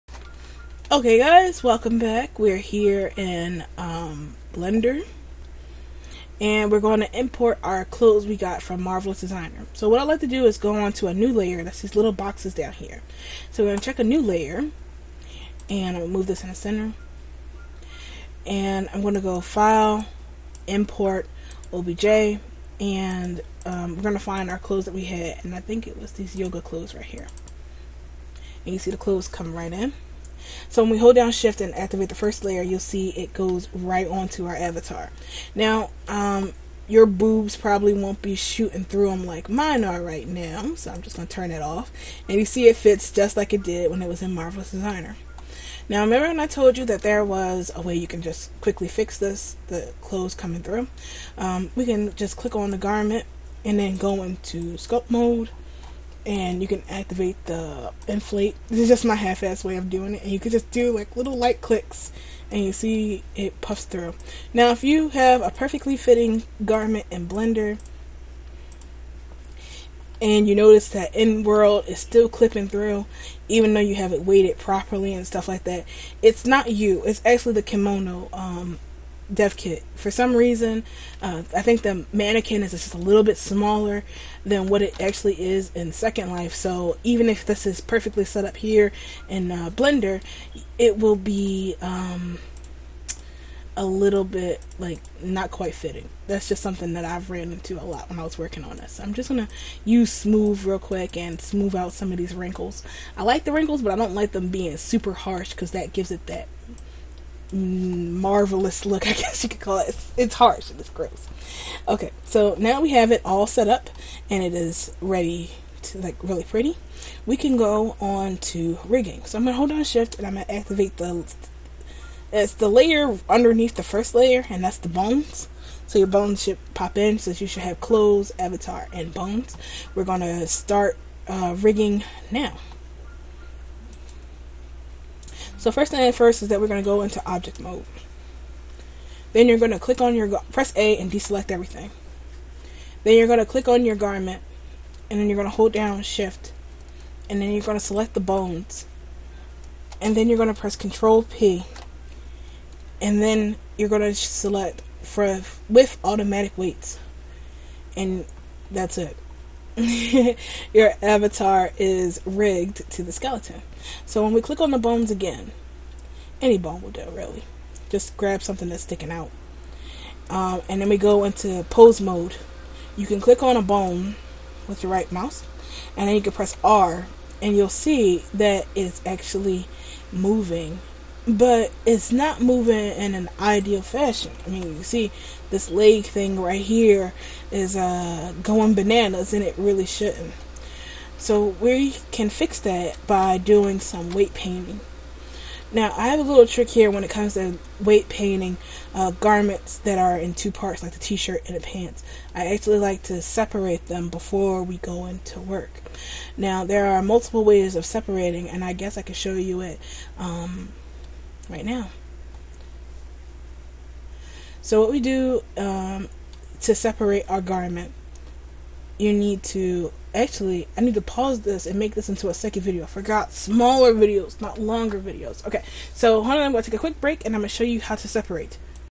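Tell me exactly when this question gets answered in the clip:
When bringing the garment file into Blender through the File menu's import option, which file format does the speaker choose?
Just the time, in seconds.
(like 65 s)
21 s.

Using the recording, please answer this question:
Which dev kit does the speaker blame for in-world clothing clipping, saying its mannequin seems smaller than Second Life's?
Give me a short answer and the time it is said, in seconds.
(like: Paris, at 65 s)
Kemono, at 77 s.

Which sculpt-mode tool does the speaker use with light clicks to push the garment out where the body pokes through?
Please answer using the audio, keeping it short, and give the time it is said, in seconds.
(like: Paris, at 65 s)
inflate, at 58 s.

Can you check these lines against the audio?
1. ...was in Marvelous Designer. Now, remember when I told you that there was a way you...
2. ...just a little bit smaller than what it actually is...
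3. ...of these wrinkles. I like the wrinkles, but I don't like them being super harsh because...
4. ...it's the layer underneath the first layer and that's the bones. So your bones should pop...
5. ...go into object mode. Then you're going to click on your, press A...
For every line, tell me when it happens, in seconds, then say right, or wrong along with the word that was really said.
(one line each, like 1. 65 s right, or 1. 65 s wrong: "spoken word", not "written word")
1. 44 s right
2. 82 s right
3. 102 s right
4. 122 s right
5. 136 s right.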